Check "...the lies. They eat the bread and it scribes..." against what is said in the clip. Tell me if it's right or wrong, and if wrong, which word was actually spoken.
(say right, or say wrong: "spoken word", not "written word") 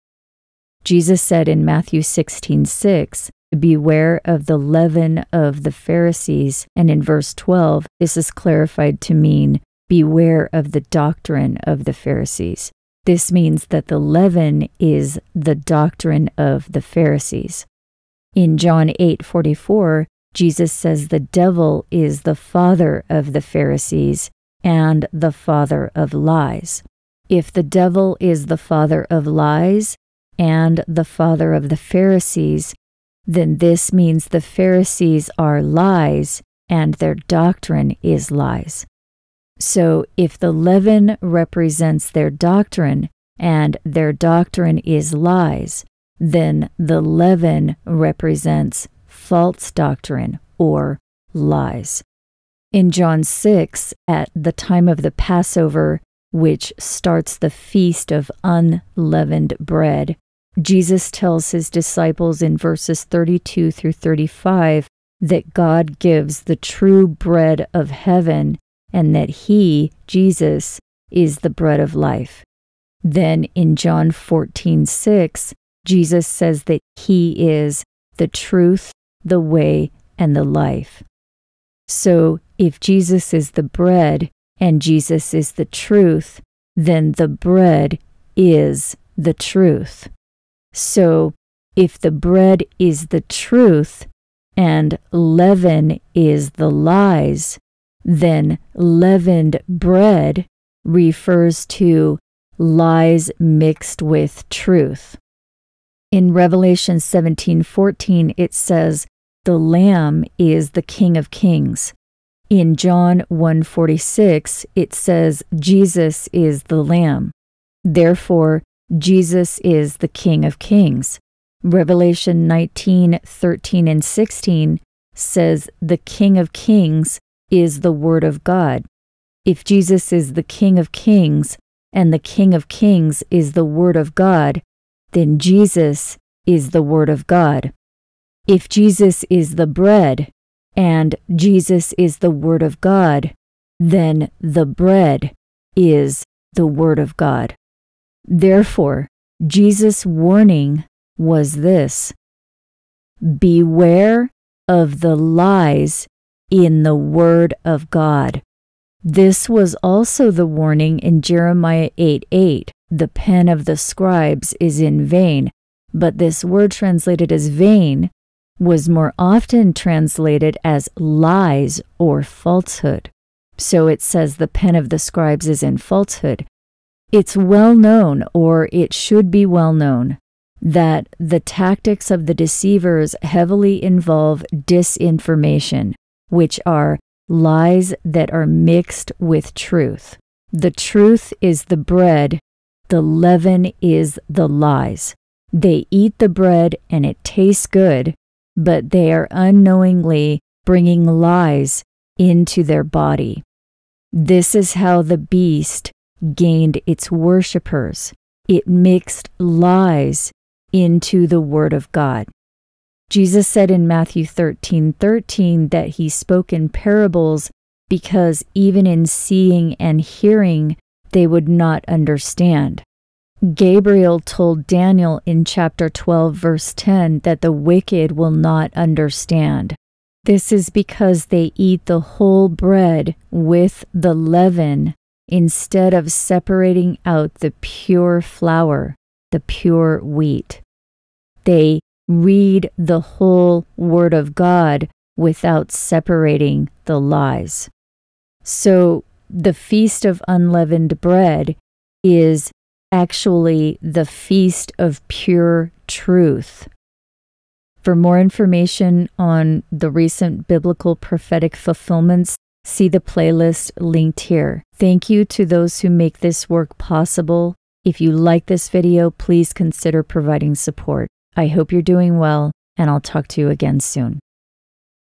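wrong: "tastes", not "scribes".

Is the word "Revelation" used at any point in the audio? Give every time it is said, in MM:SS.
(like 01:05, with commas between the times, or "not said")
01:46, 02:01.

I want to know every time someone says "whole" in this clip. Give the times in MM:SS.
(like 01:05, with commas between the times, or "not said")
03:51, 04:02.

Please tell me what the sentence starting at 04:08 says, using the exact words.
So the Feast of Unleavened Bread is actually the Feast of Pure Truth.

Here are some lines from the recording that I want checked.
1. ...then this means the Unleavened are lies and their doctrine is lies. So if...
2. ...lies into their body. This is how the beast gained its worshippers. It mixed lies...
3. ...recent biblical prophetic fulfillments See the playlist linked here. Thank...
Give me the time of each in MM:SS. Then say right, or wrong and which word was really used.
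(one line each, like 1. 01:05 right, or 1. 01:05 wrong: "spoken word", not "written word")
1. 00:33 wrong: "Pharisees", not "Unleavened"
2. 03:21 right
3. 04:19 right.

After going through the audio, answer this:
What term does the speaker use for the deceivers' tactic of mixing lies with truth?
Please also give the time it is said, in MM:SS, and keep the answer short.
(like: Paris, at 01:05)
disinformation, at 03:04.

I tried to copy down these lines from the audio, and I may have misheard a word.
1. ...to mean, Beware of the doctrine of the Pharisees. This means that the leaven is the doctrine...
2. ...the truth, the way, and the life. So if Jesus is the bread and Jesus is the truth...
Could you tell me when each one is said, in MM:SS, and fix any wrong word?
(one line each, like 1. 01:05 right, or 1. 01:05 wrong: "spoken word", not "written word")
1. 00:09 right
2. 01:18 right.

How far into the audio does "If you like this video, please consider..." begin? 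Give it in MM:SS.
04:27.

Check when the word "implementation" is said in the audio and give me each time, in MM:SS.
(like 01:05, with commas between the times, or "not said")
not said.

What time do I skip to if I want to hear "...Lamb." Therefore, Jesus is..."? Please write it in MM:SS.
01:56.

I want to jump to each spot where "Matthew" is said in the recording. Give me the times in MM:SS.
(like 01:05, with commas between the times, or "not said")
00:01, 03:33.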